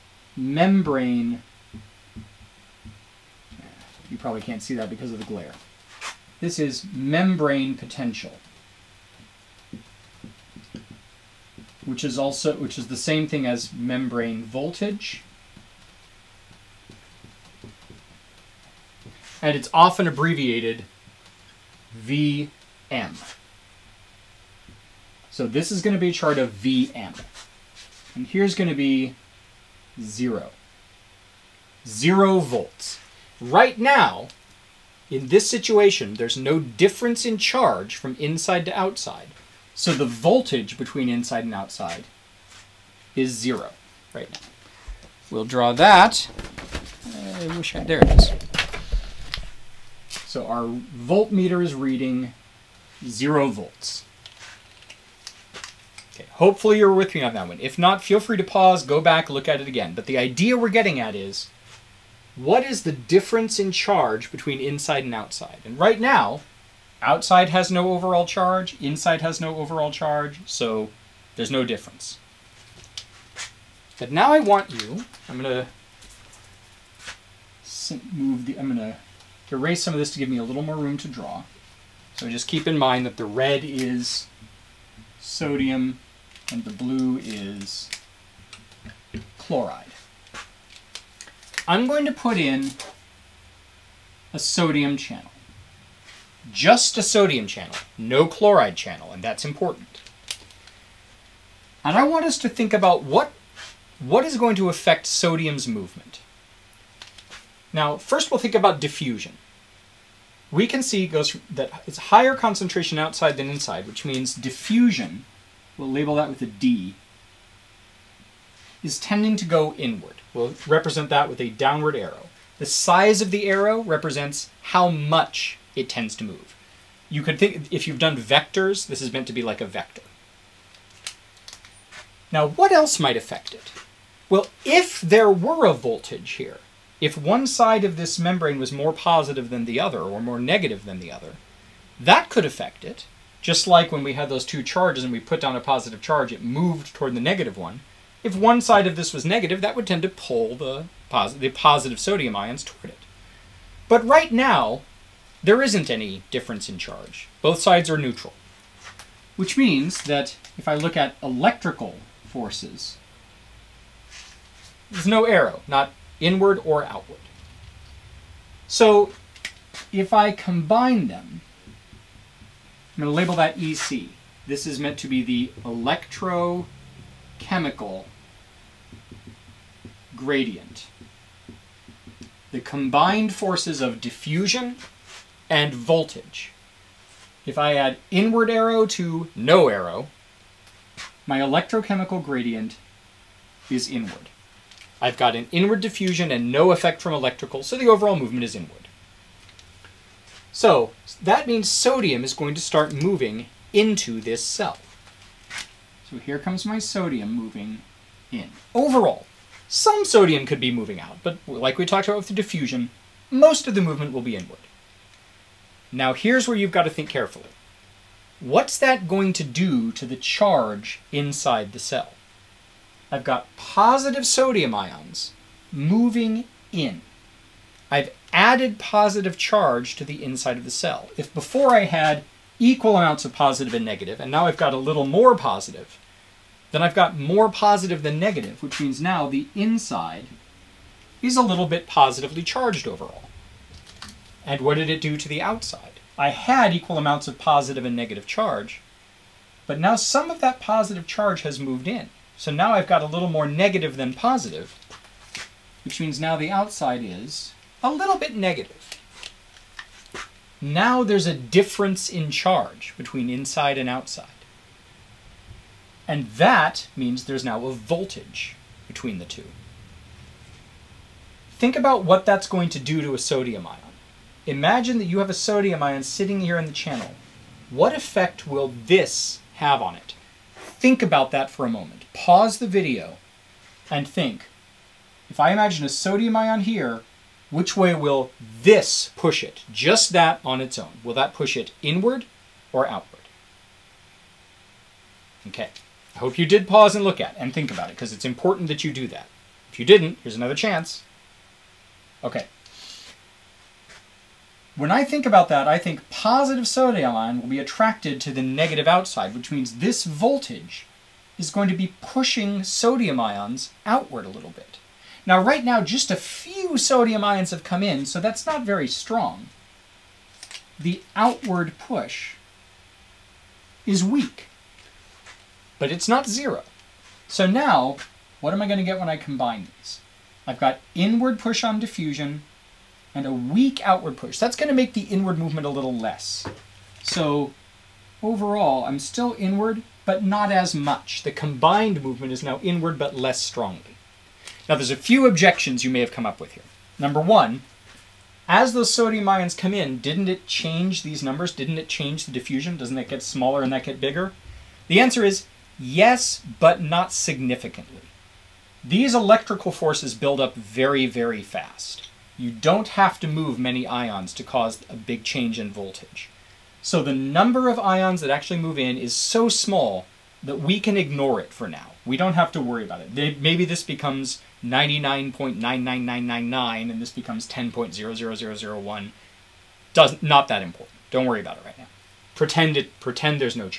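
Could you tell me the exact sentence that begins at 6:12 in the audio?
We don't have to worry about it.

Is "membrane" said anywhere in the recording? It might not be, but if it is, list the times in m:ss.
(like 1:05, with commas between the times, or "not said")
0:00, 0:06, 0:13, 2:18.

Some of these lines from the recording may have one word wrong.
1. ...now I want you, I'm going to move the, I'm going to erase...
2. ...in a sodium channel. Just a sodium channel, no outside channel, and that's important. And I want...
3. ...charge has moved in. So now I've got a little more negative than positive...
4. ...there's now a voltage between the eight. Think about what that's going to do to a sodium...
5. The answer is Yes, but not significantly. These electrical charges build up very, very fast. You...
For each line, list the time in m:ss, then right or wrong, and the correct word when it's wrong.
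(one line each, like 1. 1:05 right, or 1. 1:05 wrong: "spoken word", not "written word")
1. 1:14 right
2. 1:32 wrong: "chloride", not "outside"
3. 4:11 right
4. 4:27 wrong: "two", not "eight"
5. 5:54 wrong: "forces", not "charges".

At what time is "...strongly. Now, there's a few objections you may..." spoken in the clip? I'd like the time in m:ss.
5:43.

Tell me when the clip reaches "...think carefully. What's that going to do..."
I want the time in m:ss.
3:36.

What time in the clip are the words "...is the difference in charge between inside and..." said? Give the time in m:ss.
1:02.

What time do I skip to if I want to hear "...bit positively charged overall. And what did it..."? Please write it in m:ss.
4:01.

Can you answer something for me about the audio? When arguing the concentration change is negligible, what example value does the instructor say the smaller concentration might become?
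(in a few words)
10.00001.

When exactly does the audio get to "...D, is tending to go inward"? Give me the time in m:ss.
1:56.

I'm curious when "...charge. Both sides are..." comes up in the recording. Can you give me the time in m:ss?
2:36.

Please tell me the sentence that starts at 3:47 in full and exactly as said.
I've added positive charge to the inside of the cell.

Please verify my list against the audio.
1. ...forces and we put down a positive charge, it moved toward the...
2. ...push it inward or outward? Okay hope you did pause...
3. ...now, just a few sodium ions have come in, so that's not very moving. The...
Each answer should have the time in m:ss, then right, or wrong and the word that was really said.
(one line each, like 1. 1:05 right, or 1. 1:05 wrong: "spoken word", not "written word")
1. 2:24 wrong: "charges", not "forces"
2. 4:51 right
3. 5:15 wrong: "strong", not "moving".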